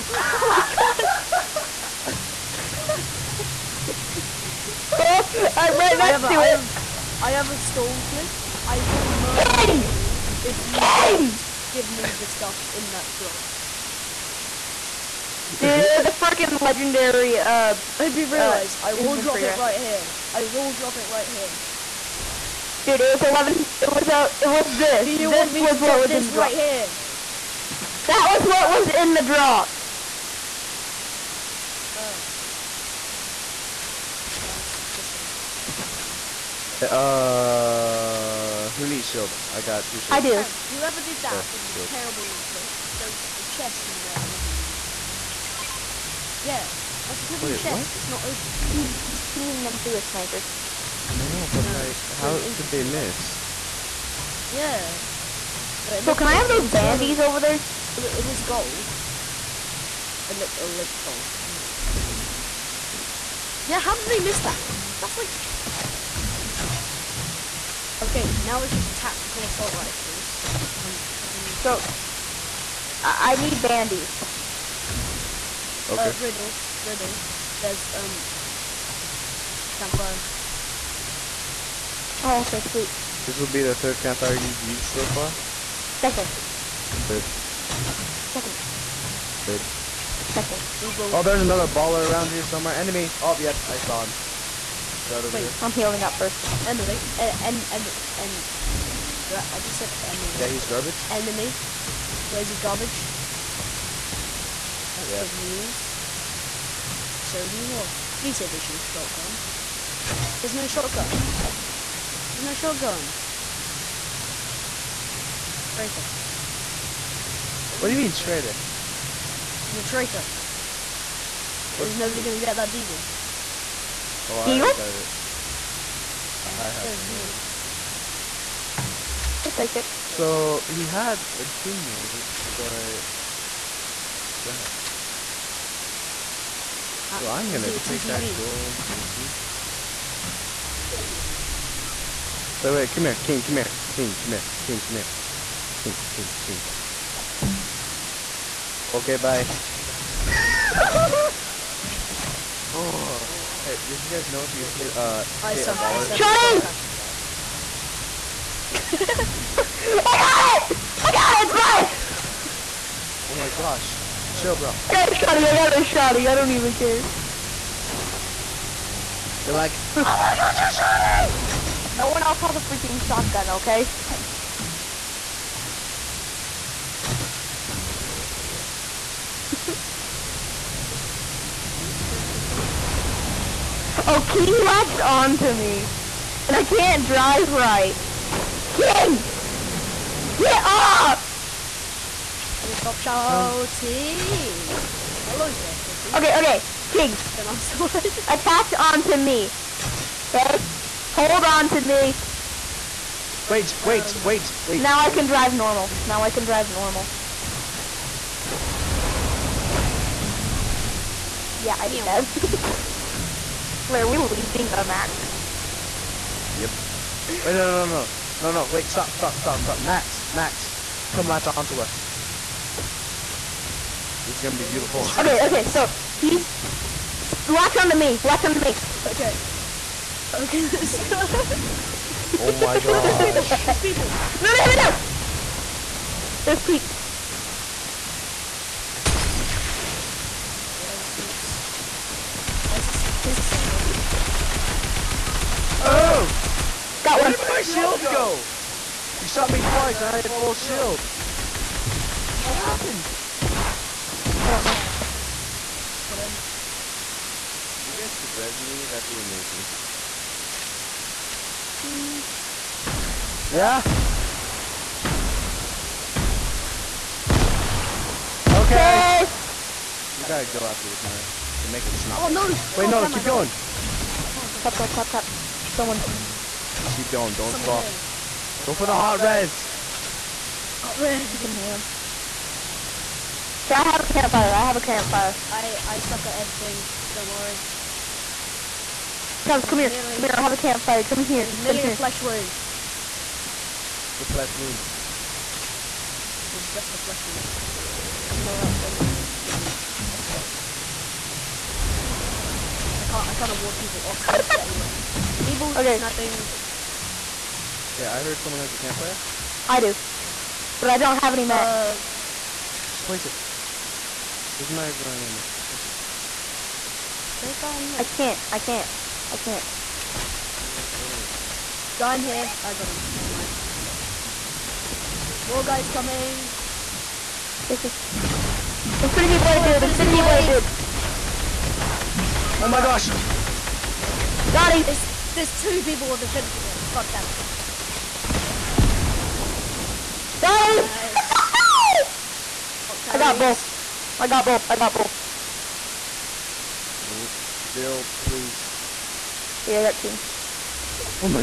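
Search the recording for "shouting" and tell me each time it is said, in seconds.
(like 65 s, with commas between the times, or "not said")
192 s.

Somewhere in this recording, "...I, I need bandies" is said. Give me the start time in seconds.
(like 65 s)
73 s.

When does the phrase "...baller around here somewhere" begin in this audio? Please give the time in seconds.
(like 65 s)
91 s.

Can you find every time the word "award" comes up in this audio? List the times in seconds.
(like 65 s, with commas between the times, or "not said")
303 s.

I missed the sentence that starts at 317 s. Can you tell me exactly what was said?
Is there a guy in there?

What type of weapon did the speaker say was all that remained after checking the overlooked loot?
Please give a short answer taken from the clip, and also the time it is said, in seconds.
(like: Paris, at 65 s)
tactical assault rifles, at 68 s.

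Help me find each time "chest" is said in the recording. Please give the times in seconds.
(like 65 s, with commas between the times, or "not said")
43 s, 47 s.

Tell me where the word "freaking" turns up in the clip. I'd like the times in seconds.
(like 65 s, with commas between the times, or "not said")
16 s, 172 s.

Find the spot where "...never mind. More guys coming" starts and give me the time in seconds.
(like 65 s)
323 s.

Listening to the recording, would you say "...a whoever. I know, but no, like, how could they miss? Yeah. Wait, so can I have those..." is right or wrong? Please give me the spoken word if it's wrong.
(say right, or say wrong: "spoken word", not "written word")
wrong: "sniper", not "whoever".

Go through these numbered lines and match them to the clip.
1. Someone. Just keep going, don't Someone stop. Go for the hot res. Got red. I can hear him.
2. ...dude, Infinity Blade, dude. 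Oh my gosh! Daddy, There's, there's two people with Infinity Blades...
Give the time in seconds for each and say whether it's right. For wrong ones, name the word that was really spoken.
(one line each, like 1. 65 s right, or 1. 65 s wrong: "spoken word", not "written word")
1. 275 s right
2. 329 s right.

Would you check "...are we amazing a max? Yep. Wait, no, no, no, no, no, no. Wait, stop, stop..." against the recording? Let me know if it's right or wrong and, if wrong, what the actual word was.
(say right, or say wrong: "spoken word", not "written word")
wrong: "leaving", not "amazing".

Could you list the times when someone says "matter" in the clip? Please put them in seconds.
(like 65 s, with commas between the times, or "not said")
314 s.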